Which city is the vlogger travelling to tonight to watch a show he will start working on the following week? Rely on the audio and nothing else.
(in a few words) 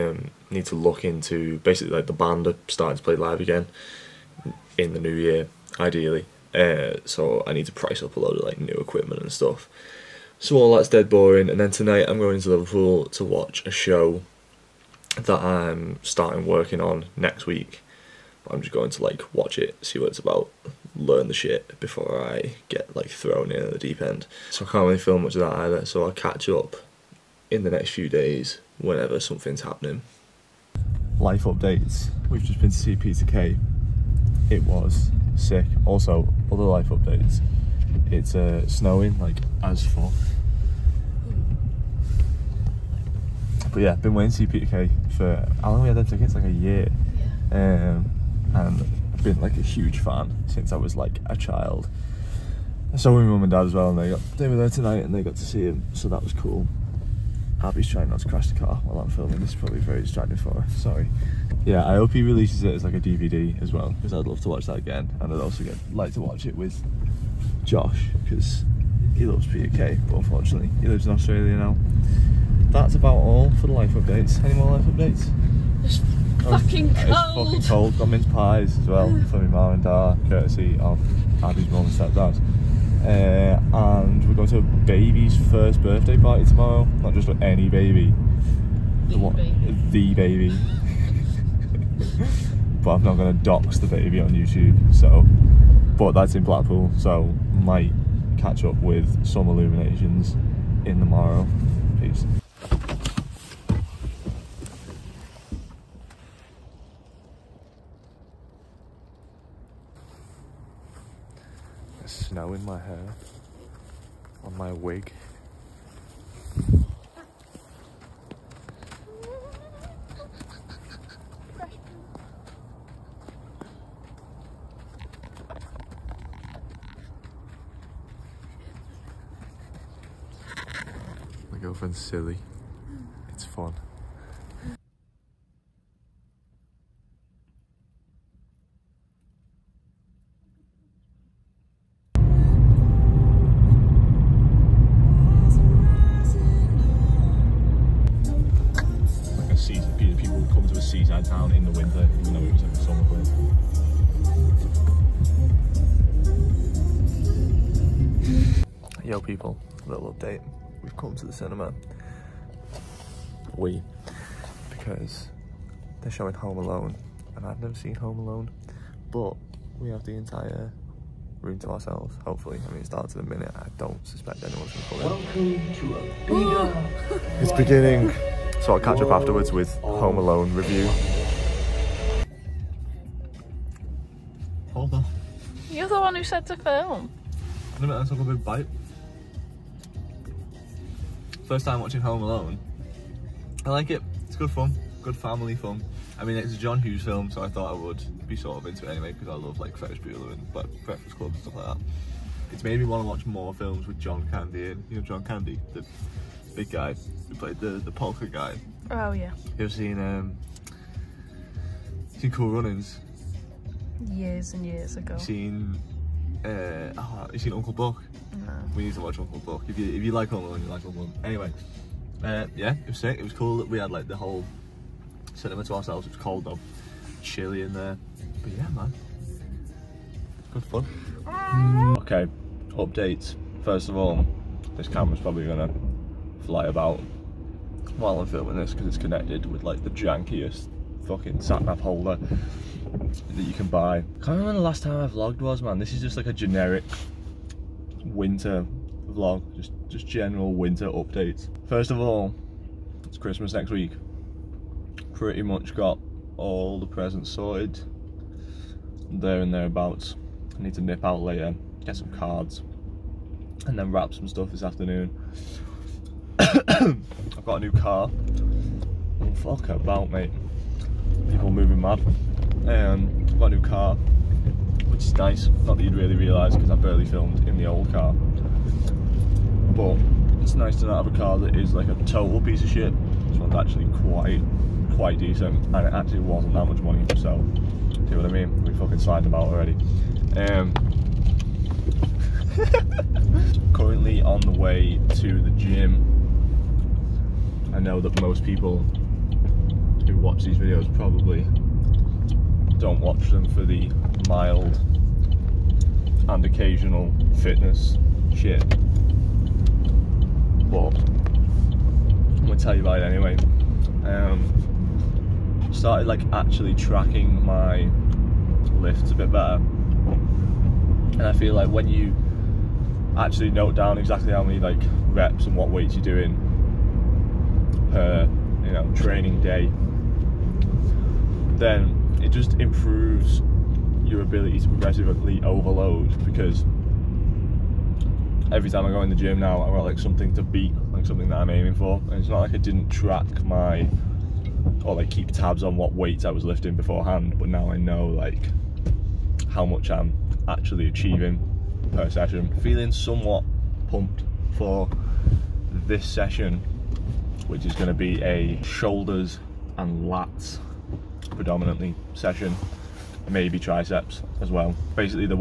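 Liverpool.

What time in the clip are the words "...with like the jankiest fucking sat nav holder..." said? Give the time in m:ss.
3:59.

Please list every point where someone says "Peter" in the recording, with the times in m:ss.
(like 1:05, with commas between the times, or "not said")
0:32, 0:44.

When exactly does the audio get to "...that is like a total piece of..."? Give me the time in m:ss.
4:41.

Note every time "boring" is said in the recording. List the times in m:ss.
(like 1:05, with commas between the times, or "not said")
0:11.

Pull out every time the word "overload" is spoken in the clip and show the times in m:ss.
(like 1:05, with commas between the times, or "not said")
5:35.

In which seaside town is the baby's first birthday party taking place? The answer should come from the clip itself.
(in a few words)
Blackpool.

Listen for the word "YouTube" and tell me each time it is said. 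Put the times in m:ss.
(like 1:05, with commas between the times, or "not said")
1:34.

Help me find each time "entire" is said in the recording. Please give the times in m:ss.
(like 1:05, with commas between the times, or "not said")
2:50.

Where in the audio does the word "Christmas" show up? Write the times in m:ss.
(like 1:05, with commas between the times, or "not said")
4:13.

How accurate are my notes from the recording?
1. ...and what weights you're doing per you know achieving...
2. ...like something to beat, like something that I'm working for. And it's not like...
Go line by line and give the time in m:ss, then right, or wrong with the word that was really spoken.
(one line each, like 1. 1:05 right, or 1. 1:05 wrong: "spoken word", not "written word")
1. 5:25 wrong: "training", not "achieving"
2. 5:39 wrong: "aiming", not "working".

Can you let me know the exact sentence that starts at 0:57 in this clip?
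Abby's trying not to crash the car while I'm filming.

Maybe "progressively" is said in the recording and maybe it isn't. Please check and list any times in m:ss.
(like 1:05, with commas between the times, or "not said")
5:34.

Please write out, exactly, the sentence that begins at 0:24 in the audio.
So I can't really film much of that either.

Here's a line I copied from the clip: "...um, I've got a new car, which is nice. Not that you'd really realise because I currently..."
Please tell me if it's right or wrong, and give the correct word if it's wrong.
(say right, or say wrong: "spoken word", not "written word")
wrong: "barely", not "currently".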